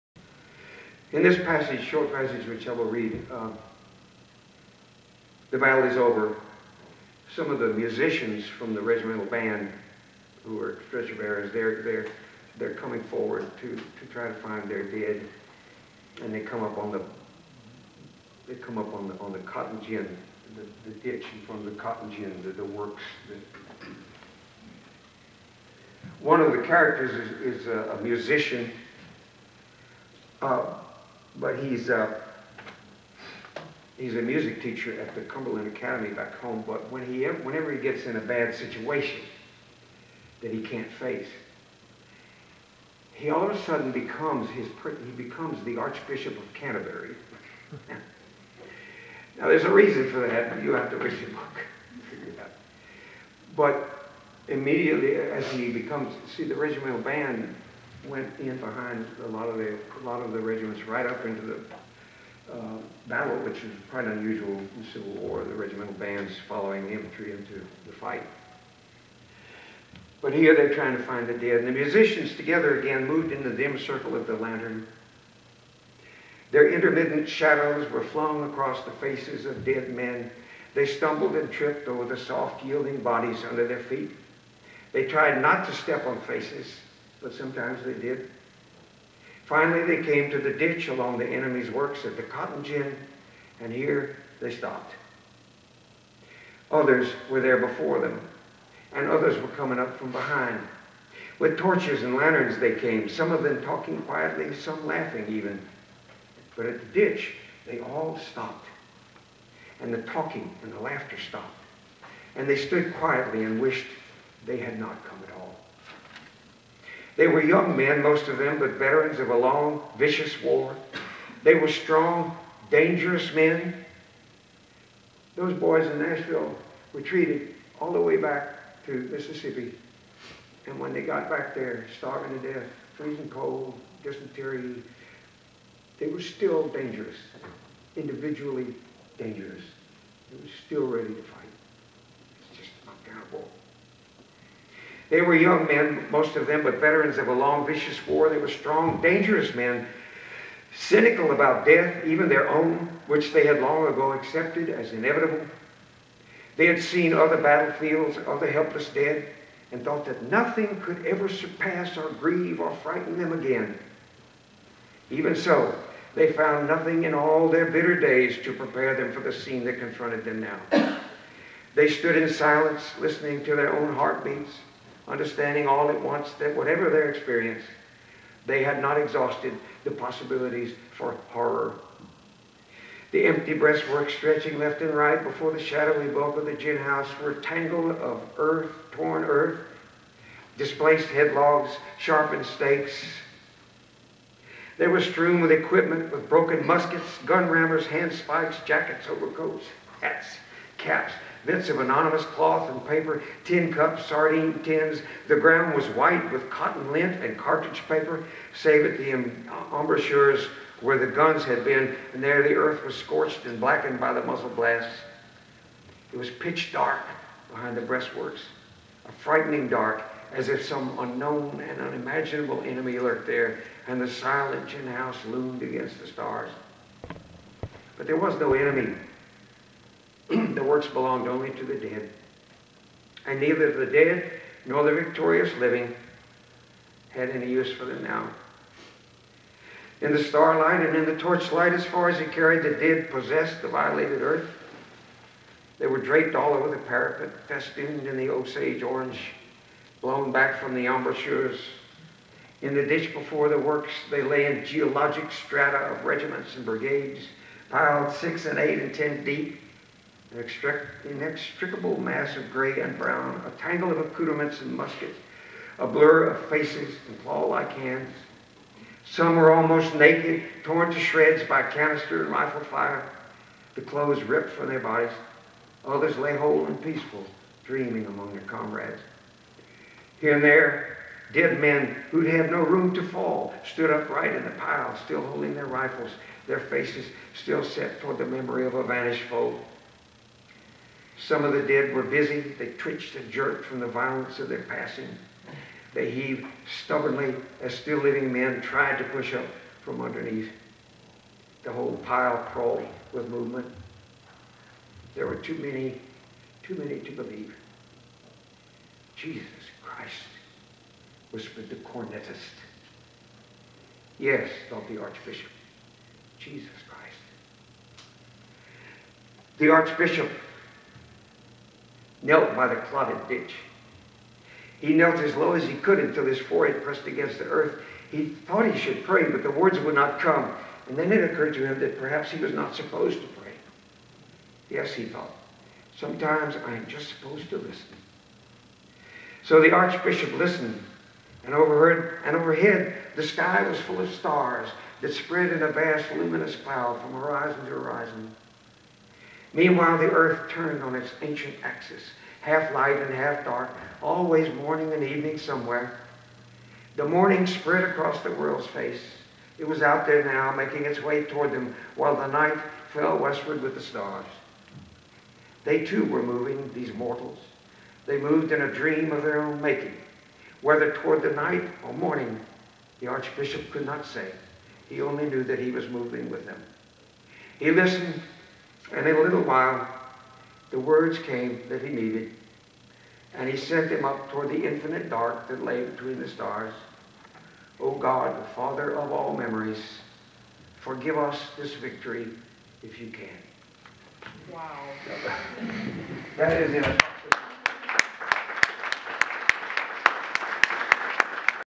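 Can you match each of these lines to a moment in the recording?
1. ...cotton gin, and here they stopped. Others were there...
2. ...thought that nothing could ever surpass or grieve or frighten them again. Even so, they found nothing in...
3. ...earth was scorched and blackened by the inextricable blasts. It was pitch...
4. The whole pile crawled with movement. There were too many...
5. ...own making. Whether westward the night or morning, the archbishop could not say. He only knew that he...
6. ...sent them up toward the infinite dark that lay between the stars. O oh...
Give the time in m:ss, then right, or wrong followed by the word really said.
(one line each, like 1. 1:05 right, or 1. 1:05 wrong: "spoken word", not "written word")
1. 1:32 right
2. 2:39 right
3. 3:32 wrong: "muzzle", not "inextricable"
4. 5:01 right
5. 6:09 wrong: "toward", not "westward"
6. 6:23 right.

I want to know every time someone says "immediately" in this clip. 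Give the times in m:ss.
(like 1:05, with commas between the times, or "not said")
0:54.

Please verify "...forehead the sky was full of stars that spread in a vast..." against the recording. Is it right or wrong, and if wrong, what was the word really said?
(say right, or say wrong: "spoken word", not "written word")
wrong: "overhead", not "forehead".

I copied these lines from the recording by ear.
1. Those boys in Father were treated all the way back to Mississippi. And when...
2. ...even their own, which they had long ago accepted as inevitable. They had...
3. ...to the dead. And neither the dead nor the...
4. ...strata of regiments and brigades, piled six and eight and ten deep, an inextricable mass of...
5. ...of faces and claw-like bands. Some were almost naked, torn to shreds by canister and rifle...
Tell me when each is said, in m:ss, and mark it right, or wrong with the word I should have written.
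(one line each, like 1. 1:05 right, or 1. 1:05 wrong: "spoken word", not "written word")
1. 2:05 wrong: "Nashville", not "Father"
2. 2:32 right
3. 3:51 right
4. 4:15 right
5. 4:26 wrong: "hands", not "bands".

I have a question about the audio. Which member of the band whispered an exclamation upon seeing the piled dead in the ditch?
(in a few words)
the cornetist.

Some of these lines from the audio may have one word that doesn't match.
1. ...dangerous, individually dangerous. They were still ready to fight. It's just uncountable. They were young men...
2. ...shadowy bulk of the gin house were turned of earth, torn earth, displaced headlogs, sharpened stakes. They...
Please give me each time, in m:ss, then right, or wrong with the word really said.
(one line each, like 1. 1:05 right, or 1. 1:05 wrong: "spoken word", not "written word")
1. 2:16 right
2. 3:05 wrong: "tangled", not "turned".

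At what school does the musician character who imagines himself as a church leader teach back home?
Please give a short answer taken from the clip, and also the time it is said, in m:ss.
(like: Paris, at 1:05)
Cumberland Academy, at 0:35.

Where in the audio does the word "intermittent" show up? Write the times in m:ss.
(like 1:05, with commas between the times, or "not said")
1:16.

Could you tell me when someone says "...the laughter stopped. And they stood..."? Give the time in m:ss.
1:50.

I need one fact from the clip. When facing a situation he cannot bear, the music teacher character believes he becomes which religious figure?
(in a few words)
Archbishop of Canterbury.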